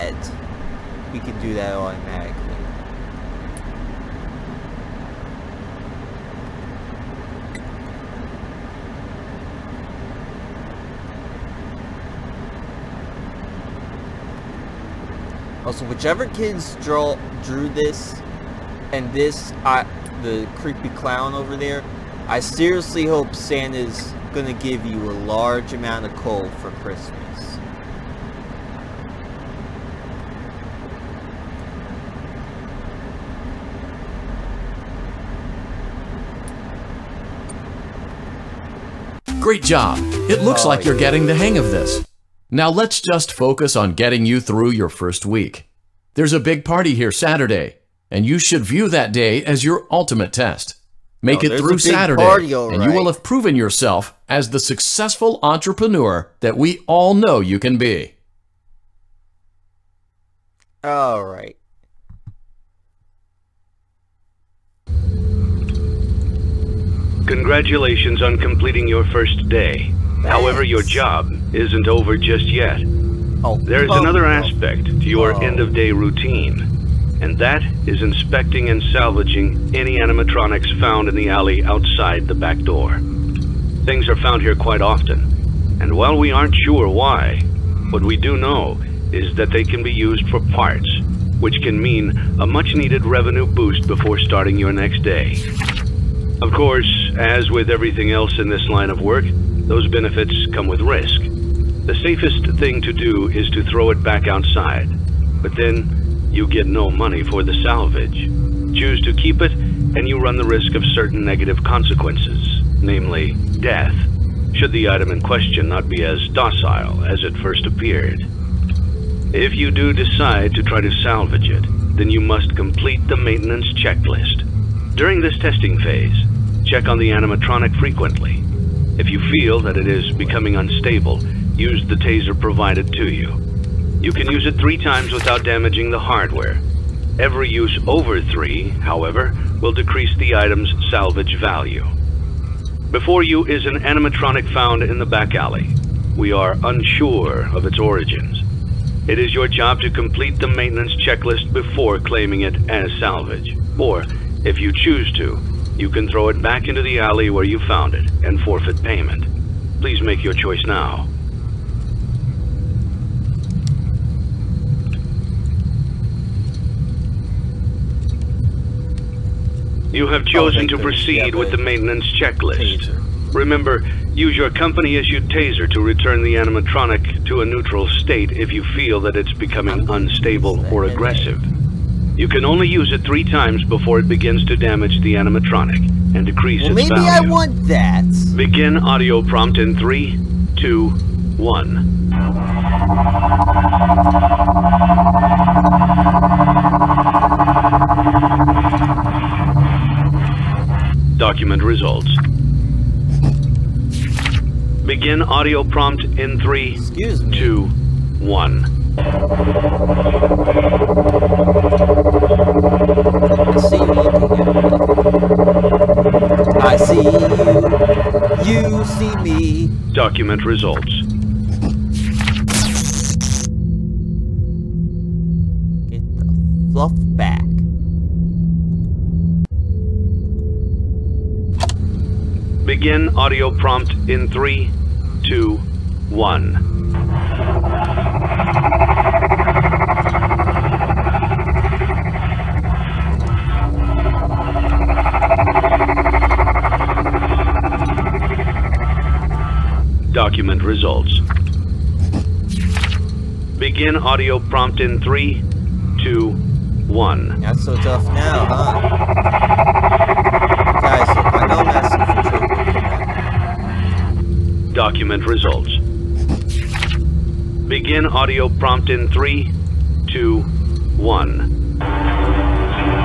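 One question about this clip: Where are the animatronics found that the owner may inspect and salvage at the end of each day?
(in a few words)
The alley outside the back door.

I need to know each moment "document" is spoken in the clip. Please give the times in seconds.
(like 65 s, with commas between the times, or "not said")
201 s, 220 s, 250 s, 264 s.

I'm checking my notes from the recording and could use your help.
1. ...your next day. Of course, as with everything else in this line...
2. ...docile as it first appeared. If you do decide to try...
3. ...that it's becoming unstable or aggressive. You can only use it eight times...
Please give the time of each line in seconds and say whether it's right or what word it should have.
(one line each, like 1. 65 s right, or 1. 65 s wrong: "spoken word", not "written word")
1. 94 s right
2. 116 s right
3. 179 s wrong: "three", not "eight".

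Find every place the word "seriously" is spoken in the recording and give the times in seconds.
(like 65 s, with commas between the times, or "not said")
22 s.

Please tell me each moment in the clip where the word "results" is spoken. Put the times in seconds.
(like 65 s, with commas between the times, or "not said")
201 s, 220 s, 250 s, 265 s.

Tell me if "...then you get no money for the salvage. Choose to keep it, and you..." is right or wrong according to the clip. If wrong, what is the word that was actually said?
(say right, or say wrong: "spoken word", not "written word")
right.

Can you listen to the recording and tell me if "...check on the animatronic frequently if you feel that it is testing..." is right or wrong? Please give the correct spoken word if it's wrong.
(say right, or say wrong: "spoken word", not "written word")
wrong: "becoming", not "testing".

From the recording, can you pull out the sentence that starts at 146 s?
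We are unsure of its origins.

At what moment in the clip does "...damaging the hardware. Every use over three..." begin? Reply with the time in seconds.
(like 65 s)
135 s.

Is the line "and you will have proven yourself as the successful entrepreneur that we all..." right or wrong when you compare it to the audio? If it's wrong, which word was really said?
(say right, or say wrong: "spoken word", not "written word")
right.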